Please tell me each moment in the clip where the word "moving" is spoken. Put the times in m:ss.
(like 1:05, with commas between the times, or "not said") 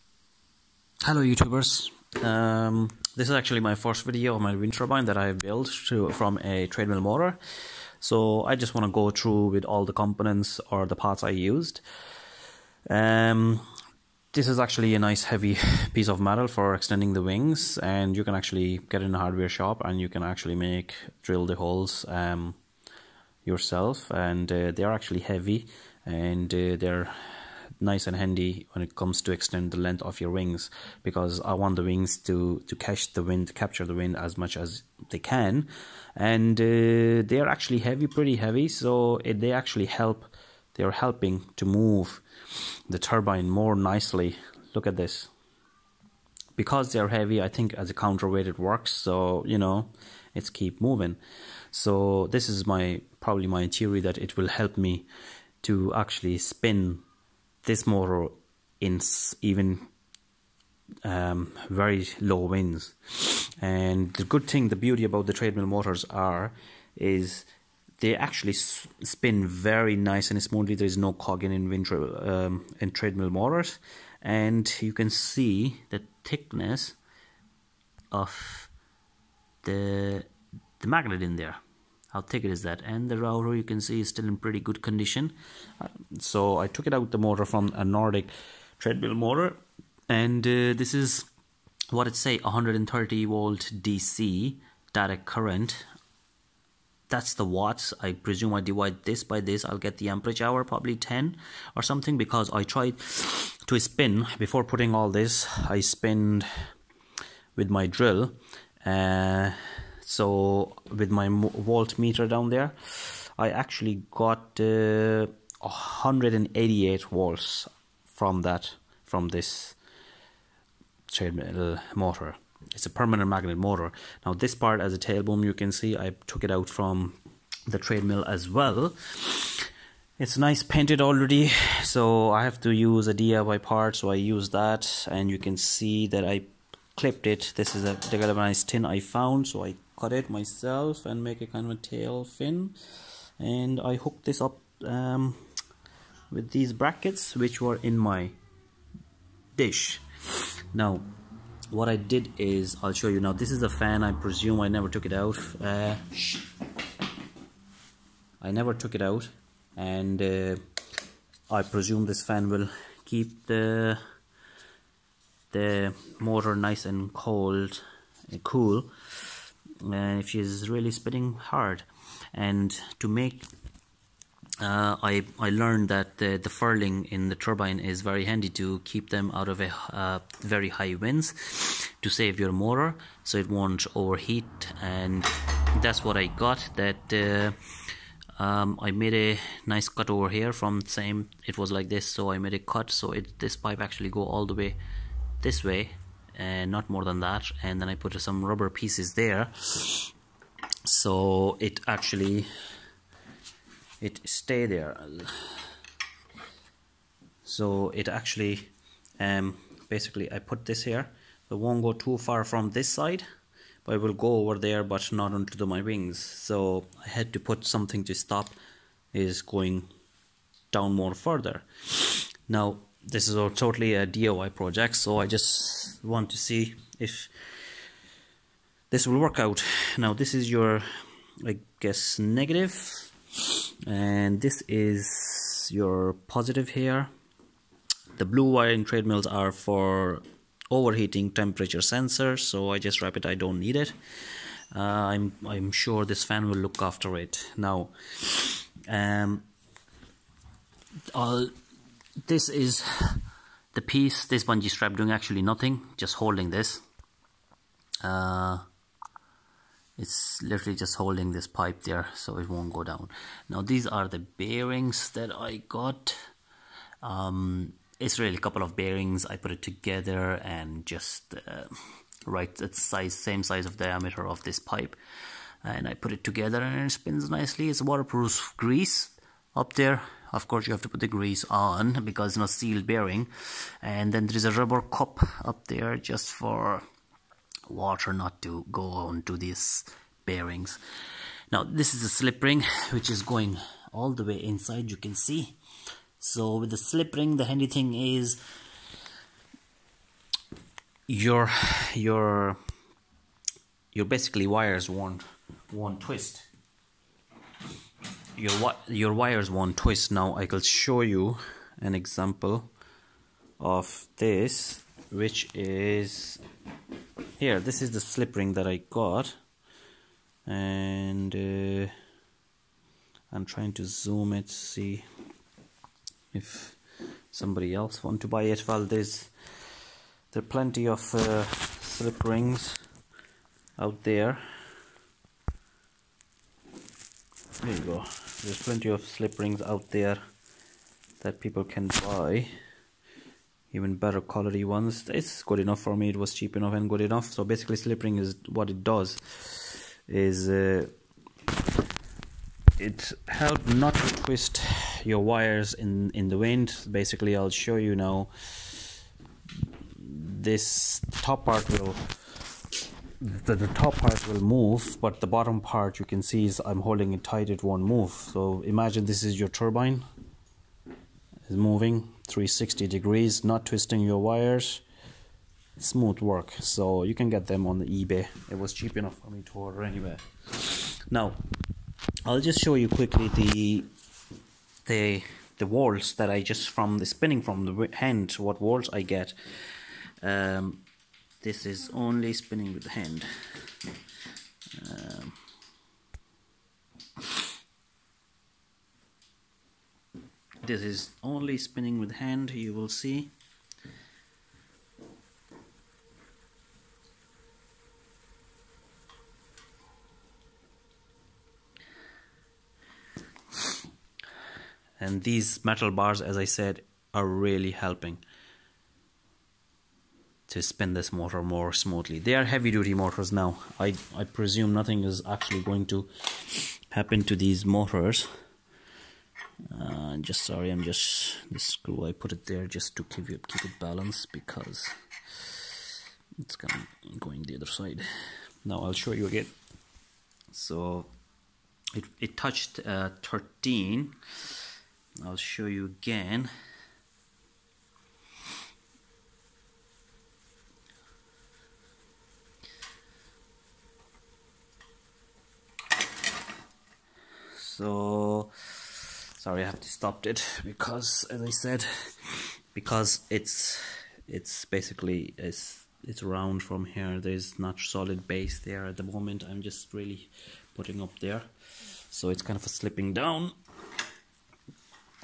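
0:50, 6:11.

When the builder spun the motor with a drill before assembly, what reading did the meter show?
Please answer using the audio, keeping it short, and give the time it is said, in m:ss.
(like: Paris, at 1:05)
188 volts, at 1:55.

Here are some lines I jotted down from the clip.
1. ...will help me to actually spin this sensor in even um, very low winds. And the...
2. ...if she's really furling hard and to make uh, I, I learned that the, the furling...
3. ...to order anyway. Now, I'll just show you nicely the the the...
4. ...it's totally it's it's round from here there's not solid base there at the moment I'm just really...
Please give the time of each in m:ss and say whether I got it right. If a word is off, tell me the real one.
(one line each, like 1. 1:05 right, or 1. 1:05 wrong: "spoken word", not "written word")
1. 0:54 wrong: "motor", not "sensor"
2. 2:50 wrong: "spitting", not "furling"
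3. 6:19 wrong: "quickly", not "nicely"
4. 7:44 wrong: "basically", not "totally".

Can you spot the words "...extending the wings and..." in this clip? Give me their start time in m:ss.
0:16.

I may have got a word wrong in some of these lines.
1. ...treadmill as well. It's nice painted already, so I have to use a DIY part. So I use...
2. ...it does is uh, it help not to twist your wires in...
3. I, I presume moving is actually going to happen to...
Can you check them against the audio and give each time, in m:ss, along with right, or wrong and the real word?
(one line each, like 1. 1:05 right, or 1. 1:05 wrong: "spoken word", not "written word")
1. 2:07 right
2. 5:48 right
3. 7:03 wrong: "nothing", not "moving".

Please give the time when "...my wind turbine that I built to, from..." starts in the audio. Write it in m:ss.
0:04.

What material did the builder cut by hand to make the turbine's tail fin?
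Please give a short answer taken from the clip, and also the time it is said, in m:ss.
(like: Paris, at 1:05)
galvanized tin, at 2:18.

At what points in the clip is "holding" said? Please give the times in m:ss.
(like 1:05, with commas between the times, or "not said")
4:16, 4:20, 6:06.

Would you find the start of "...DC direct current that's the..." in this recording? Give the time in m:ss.
1:33.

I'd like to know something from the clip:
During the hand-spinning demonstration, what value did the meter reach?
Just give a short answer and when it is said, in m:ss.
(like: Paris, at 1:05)
13, at 7:23.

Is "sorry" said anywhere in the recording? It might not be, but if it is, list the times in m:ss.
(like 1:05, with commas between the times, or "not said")
7:10, 7:39.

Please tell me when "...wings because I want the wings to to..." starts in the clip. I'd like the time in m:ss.
0:30.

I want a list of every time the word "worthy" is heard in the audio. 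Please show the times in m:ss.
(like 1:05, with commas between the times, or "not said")
not said.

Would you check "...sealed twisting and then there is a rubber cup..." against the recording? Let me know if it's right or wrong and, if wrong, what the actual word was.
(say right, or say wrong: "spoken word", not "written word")
wrong: "bearing", not "twisting".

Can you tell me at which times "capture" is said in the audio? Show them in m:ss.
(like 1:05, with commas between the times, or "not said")
0:33.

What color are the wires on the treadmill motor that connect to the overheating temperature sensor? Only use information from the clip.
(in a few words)
blue.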